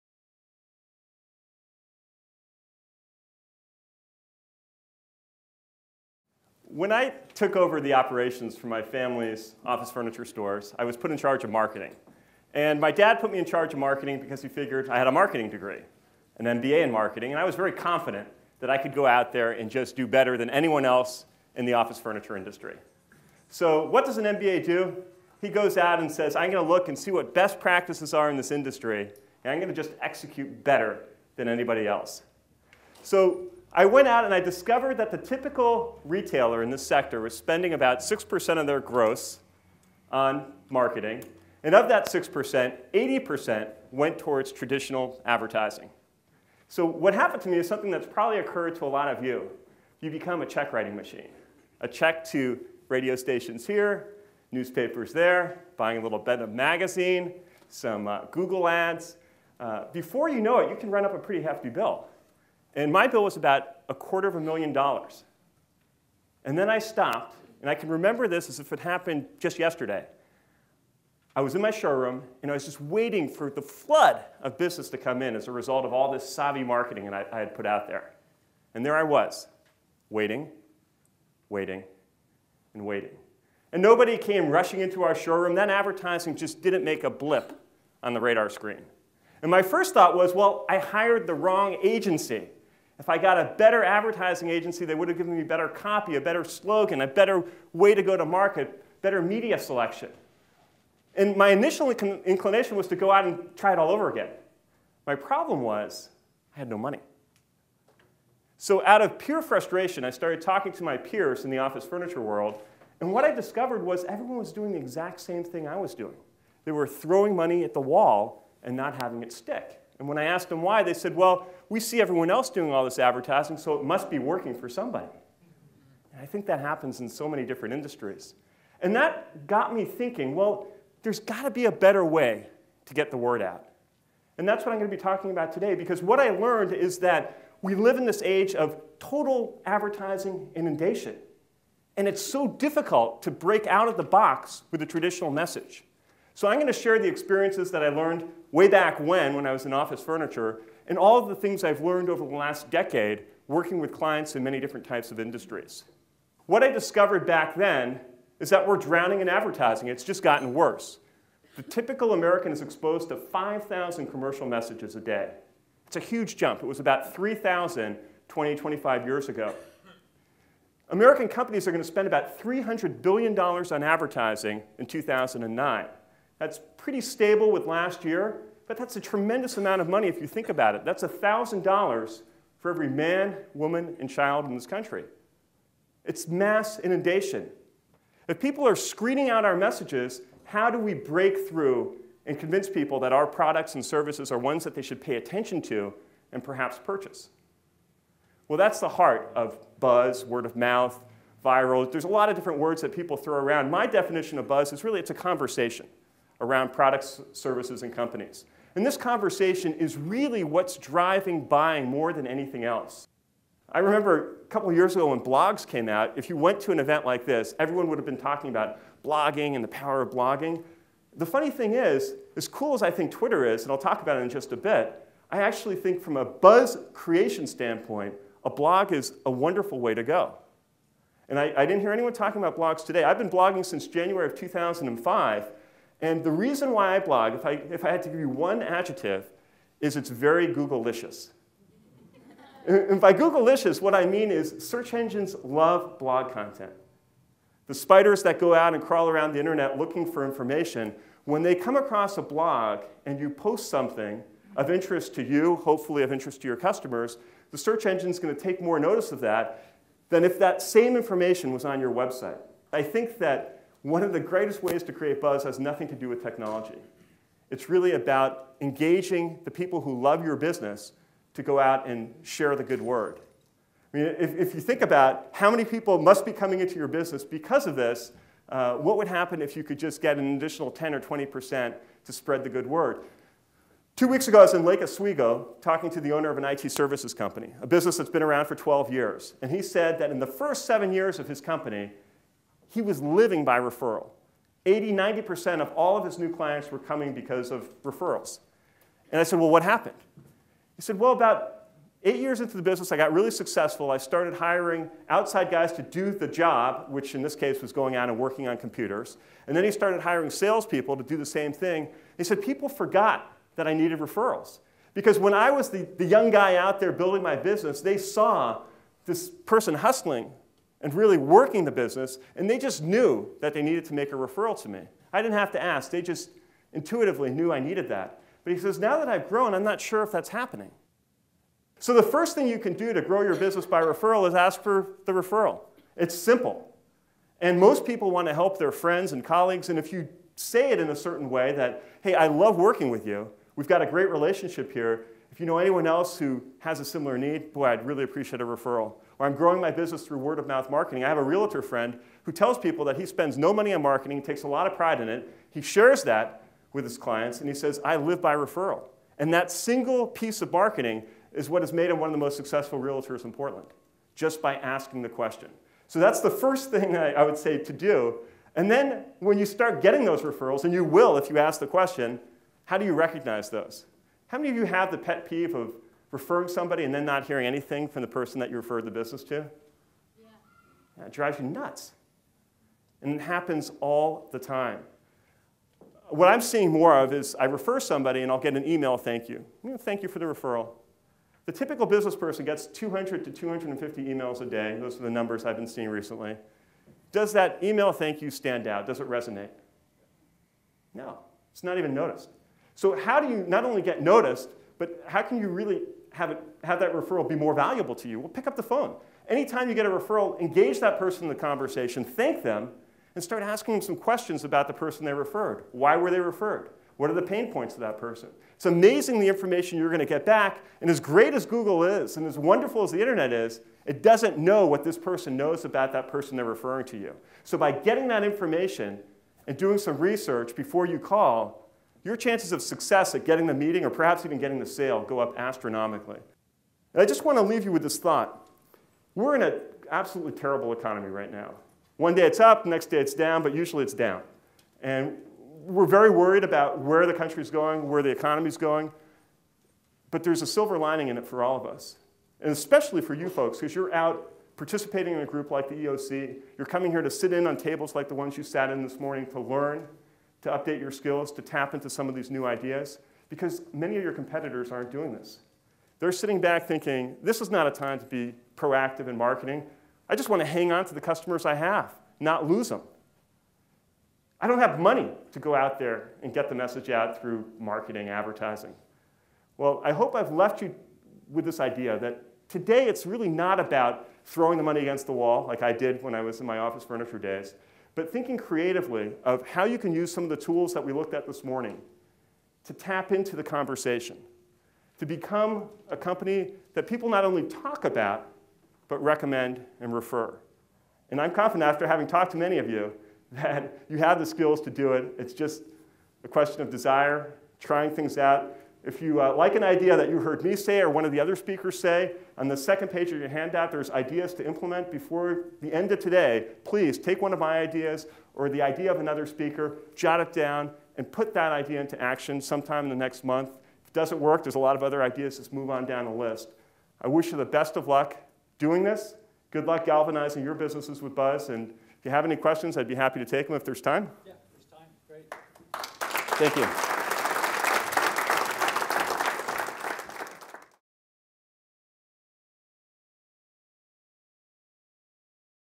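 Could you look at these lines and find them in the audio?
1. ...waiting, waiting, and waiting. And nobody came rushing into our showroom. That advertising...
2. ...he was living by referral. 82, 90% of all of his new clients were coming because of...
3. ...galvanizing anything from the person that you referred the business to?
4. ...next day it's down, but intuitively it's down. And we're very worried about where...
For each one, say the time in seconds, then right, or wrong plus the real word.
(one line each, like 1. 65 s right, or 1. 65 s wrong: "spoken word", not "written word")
1. 80 s right
2. 292 s wrong: "80", not "82"
3. 377 s wrong: "hearing", not "galvanizing"
4. 442 s wrong: "usually", not "intuitively".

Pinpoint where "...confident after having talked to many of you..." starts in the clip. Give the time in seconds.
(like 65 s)
501 s.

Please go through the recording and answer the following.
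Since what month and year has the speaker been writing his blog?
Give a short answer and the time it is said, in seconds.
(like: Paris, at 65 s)
January 2005, at 233 s.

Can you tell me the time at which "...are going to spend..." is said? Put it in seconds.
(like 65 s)
171 s.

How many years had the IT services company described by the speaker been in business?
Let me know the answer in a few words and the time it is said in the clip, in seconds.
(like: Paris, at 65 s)
12 years, at 288 s.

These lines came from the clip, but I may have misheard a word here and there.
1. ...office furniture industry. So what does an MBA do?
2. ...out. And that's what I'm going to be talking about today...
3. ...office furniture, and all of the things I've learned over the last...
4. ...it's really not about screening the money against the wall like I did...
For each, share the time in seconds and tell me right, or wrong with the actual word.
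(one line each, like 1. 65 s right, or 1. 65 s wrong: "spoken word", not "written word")
1. 21 s right
2. 133 s right
3. 149 s right
4. 482 s wrong: "throwing", not "screening".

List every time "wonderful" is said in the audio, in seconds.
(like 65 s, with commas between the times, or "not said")
229 s, 422 s.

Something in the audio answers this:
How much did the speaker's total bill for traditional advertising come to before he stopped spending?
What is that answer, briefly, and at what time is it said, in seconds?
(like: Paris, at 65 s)
a quarter of a million dollars, at 63 s.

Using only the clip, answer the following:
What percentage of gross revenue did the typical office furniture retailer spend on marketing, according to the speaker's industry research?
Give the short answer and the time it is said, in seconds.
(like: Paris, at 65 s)
6%, at 37 s.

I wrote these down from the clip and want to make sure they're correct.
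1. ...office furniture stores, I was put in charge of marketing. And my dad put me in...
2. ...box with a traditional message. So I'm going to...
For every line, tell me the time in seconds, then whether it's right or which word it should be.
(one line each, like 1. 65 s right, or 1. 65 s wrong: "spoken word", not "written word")
1. 9 s right
2. 144 s right.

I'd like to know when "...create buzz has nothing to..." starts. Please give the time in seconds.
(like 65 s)
264 s.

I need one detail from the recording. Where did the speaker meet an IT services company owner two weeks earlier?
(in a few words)
Lake Oswego.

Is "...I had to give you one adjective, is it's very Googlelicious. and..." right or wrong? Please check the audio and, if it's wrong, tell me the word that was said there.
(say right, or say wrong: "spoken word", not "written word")
right.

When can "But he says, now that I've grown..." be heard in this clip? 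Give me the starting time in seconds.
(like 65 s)
328 s.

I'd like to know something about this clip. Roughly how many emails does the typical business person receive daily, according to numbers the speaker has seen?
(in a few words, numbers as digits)
200 to 250.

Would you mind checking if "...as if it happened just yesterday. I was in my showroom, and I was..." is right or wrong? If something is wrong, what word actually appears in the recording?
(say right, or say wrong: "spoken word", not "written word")
right.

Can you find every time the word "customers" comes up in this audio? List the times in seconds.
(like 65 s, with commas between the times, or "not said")
256 s, 471 s.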